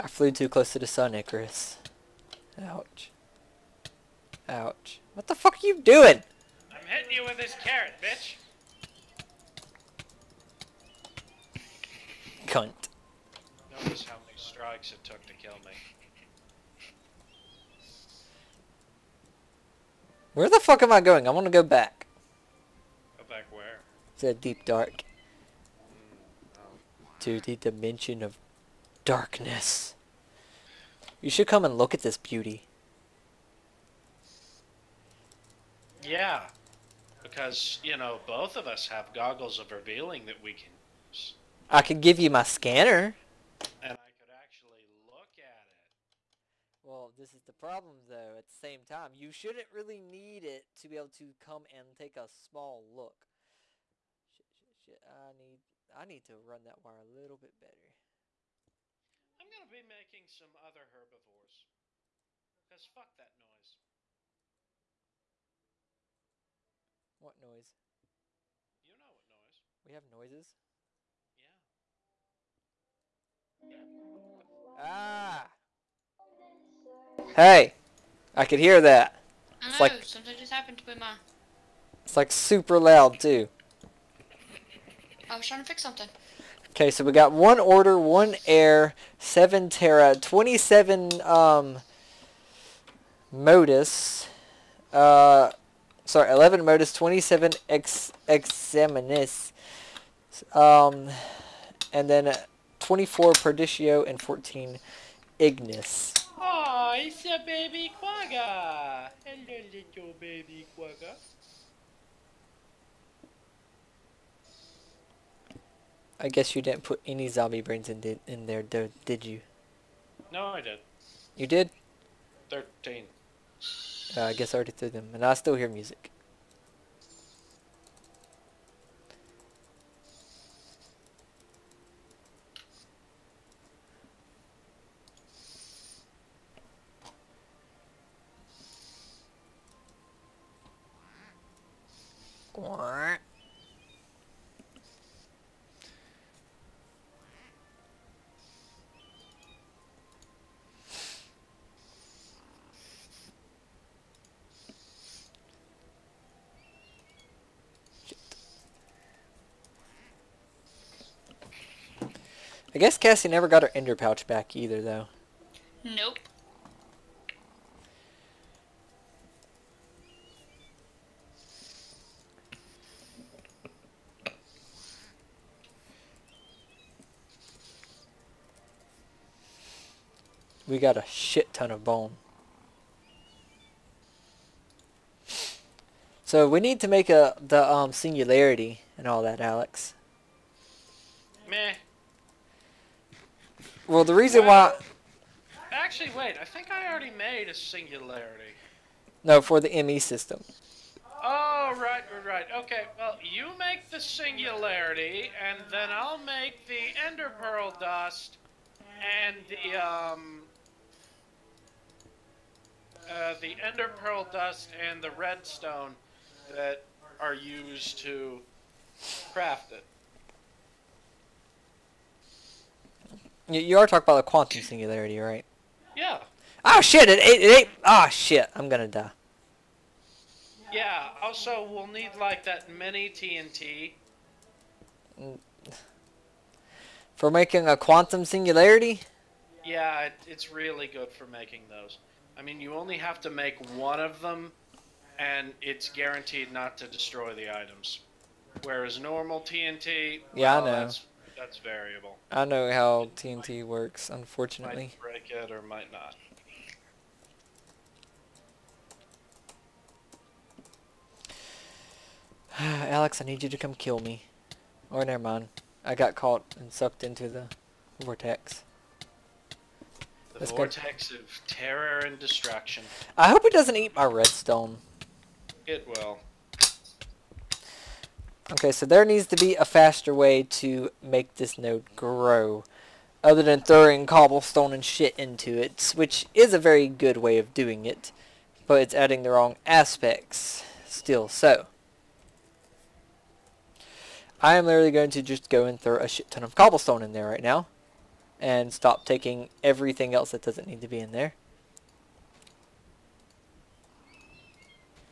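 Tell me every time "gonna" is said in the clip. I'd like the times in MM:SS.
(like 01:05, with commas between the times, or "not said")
00:59, 03:48.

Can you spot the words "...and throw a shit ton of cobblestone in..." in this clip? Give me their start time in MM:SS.
04:55.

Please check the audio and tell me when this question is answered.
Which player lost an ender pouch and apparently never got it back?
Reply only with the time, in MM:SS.
02:42.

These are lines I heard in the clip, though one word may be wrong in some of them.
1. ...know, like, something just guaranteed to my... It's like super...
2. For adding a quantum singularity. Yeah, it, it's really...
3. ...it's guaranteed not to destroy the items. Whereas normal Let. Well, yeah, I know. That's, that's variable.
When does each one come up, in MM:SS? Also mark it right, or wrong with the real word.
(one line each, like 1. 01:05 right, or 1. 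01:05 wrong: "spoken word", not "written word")
1. 01:19 wrong: "happened", not "guaranteed"
2. 03:57 wrong: "making", not "adding"
3. 04:05 wrong: "TNT", not "Let".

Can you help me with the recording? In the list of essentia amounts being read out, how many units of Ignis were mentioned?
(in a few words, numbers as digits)
14.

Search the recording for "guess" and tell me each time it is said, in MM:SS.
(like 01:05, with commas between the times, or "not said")
01:56, 02:04, 02:42.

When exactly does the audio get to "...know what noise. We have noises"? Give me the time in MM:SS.
01:08.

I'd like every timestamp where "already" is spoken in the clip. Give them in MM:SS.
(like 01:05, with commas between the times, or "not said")
02:04, 03:16.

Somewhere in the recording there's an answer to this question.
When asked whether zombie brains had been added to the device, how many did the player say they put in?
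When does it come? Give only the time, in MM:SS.
02:02.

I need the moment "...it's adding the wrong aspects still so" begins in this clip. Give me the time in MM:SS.
04:48.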